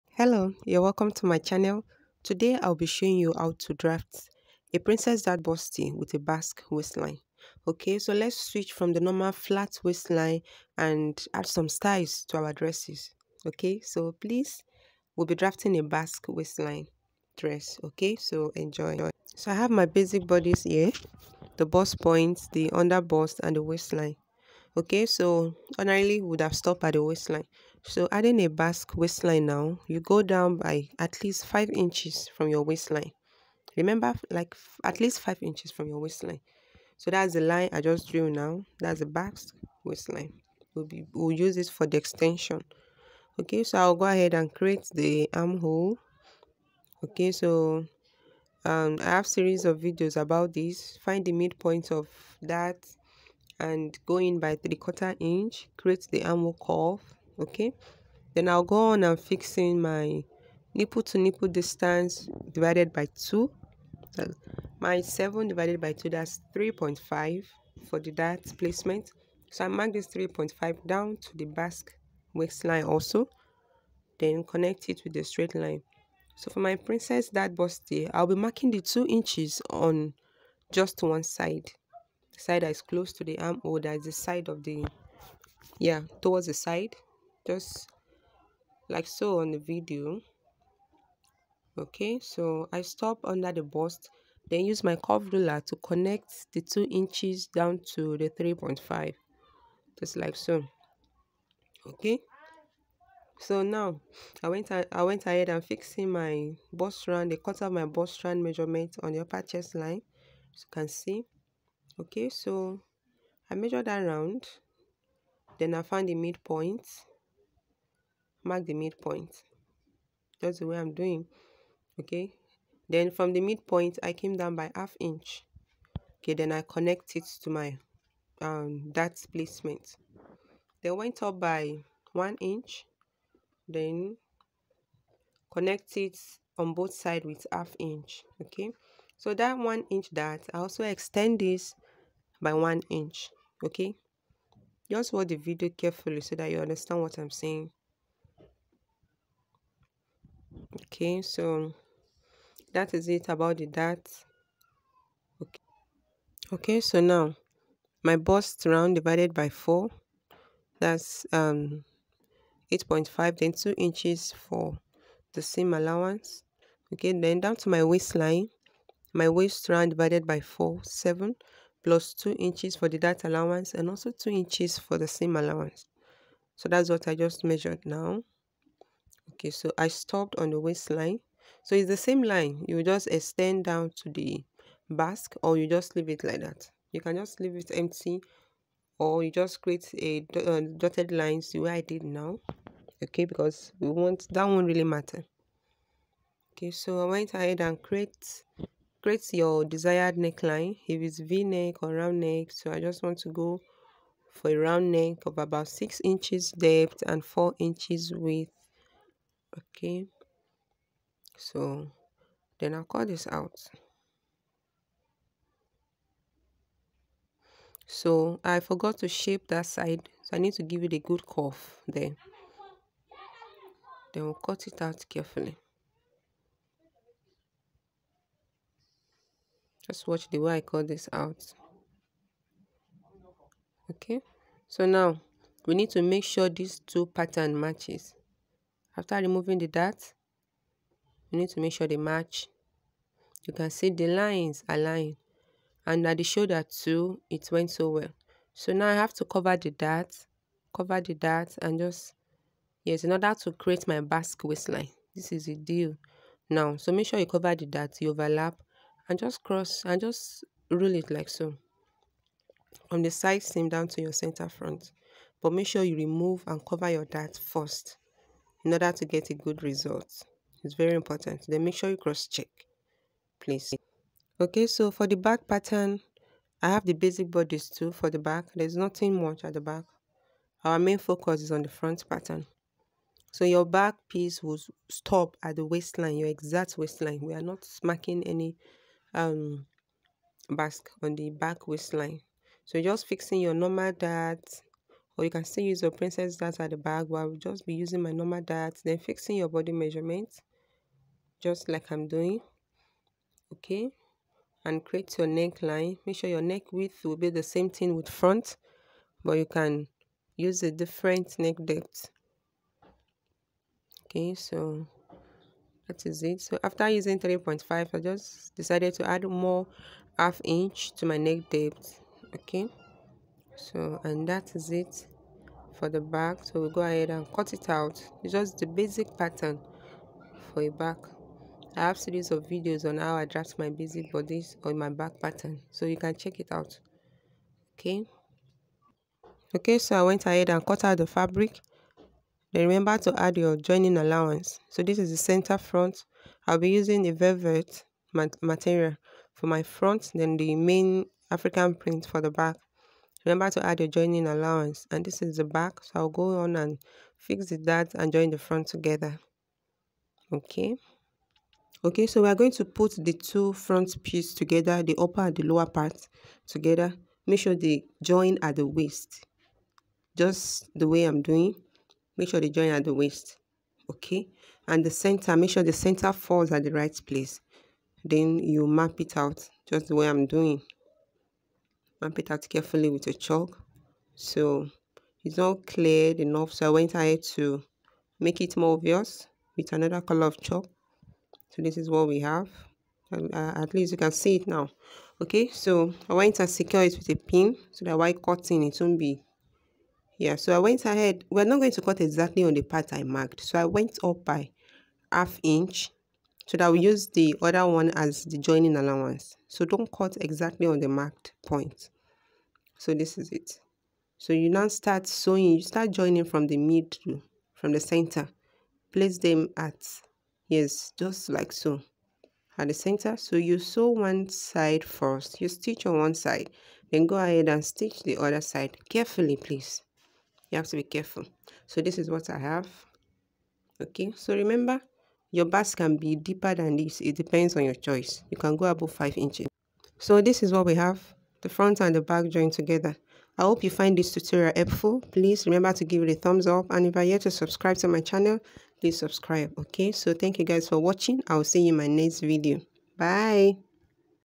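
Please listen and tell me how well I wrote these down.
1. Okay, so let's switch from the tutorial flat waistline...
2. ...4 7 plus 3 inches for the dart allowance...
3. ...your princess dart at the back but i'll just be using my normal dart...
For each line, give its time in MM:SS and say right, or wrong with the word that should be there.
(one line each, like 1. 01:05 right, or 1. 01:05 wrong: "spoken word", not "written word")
1. 00:07 wrong: "normal", not "tutorial"
2. 02:50 wrong: "2", not "3"
3. 04:55 right.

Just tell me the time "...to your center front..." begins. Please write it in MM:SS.
04:23.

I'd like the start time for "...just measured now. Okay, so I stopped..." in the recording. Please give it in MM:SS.
02:57.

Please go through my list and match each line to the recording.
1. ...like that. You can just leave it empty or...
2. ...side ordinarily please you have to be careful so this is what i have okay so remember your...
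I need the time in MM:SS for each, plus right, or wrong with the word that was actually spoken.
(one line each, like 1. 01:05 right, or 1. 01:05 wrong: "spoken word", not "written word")
1. 03:06 right
2. 07:08 wrong: "carefully", not "ordinarily".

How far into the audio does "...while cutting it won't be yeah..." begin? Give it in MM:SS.
06:37.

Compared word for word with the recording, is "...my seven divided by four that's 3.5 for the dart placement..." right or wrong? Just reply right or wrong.
wrong.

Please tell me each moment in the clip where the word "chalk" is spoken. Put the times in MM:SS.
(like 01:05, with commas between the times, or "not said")
06:23, 06:30.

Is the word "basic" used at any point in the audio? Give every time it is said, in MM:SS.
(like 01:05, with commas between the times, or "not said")
00:19, 04:36, 05:28, 05:33.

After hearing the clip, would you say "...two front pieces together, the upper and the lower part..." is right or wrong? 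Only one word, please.
right.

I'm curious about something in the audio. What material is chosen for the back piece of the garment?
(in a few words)
African print.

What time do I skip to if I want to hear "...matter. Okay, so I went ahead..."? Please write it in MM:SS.
03:14.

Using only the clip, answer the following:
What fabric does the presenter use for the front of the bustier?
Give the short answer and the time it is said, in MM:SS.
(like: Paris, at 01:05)
velvet, at 05:47.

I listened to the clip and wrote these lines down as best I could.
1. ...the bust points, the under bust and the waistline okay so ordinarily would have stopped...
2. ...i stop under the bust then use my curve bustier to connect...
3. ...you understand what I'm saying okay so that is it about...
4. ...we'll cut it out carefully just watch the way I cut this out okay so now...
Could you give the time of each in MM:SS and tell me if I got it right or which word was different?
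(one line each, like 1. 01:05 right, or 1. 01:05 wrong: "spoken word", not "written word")
1. 00:21 right
2. 01:32 wrong: "ruler", not "bustier"
3. 02:26 right
4. 03:44 right.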